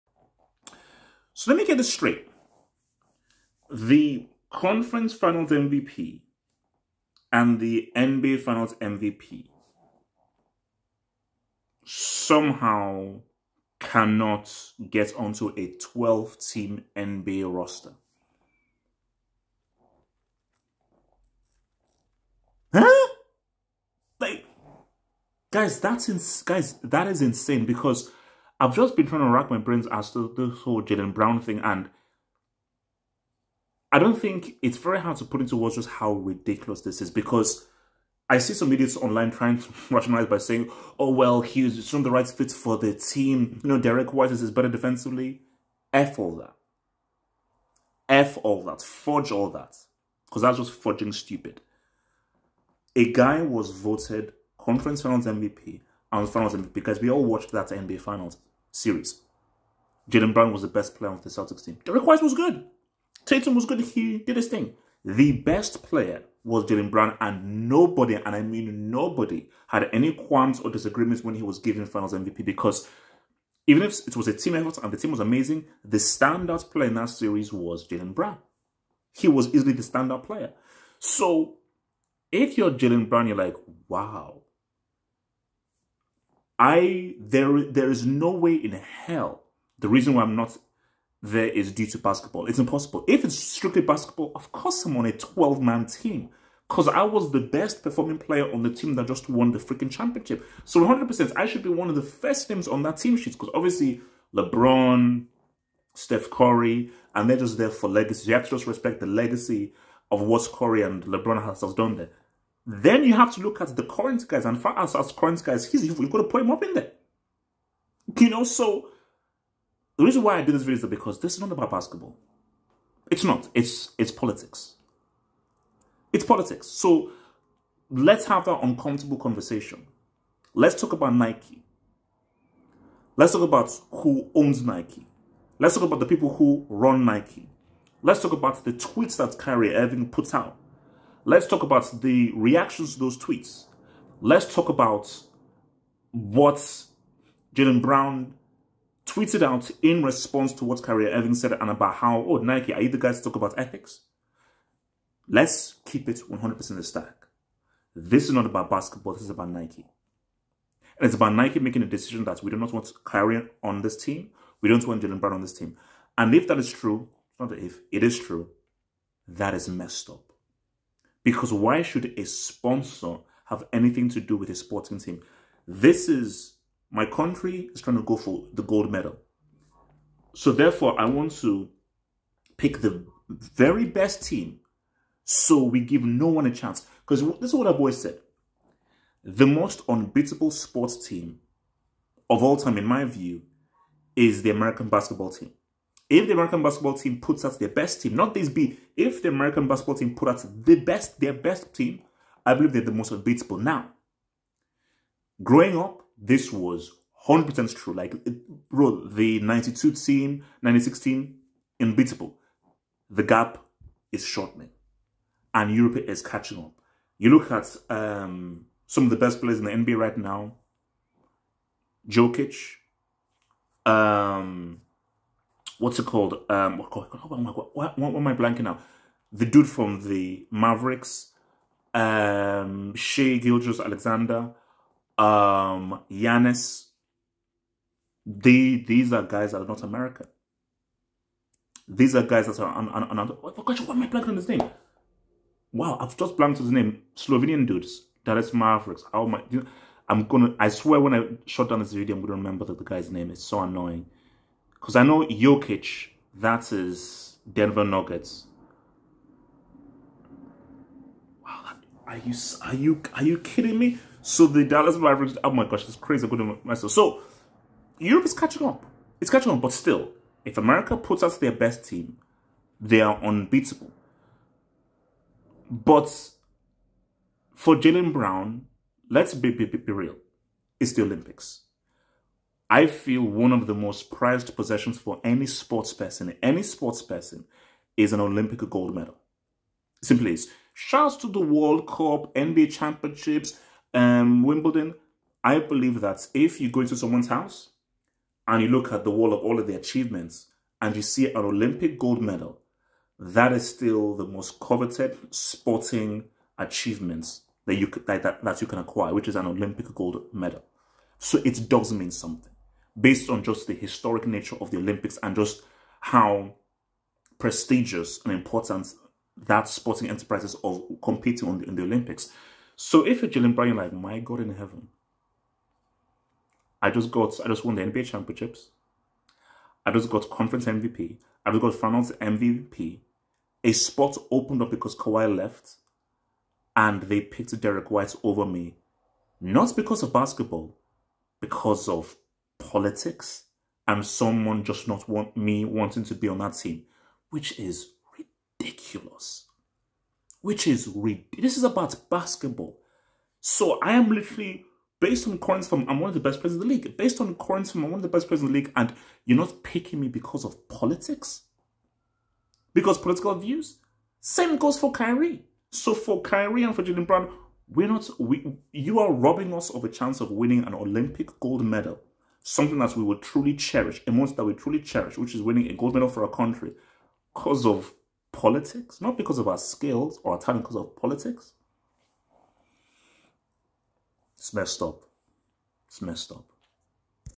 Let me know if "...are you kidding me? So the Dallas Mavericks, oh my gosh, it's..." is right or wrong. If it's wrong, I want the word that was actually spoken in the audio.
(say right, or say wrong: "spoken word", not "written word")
right.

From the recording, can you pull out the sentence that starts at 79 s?
He was easily the standout player.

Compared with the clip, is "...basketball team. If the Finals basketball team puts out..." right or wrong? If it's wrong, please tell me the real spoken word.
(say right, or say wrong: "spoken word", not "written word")
wrong: "American", not "Finals".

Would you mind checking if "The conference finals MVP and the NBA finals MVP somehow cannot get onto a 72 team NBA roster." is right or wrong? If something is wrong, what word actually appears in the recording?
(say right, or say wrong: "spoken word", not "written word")
wrong: "12", not "72".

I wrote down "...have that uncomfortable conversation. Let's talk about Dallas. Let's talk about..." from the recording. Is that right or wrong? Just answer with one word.
wrong.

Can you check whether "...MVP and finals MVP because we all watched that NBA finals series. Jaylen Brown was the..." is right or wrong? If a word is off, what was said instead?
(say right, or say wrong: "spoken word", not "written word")
right.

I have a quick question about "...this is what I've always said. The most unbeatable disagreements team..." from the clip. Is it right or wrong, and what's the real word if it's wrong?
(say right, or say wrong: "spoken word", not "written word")
wrong: "sports", not "disagreements".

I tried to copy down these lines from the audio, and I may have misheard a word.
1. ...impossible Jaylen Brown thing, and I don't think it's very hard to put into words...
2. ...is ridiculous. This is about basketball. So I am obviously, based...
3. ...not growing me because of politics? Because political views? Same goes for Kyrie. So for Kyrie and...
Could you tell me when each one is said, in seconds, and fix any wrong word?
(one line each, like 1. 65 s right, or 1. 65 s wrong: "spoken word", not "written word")
1. 30 s wrong: "whole", not "impossible"
2. 350 s wrong: "literally", not "obviously"
3. 359 s wrong: "picking", not "growing".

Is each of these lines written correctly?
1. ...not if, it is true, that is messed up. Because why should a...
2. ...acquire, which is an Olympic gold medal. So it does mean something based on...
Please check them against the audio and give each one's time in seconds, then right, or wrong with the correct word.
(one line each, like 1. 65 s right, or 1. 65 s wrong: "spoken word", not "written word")
1. 167 s right
2. 308 s right.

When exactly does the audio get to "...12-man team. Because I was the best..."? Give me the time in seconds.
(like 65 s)
95 s.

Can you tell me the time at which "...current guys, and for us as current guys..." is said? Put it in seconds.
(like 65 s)
113 s.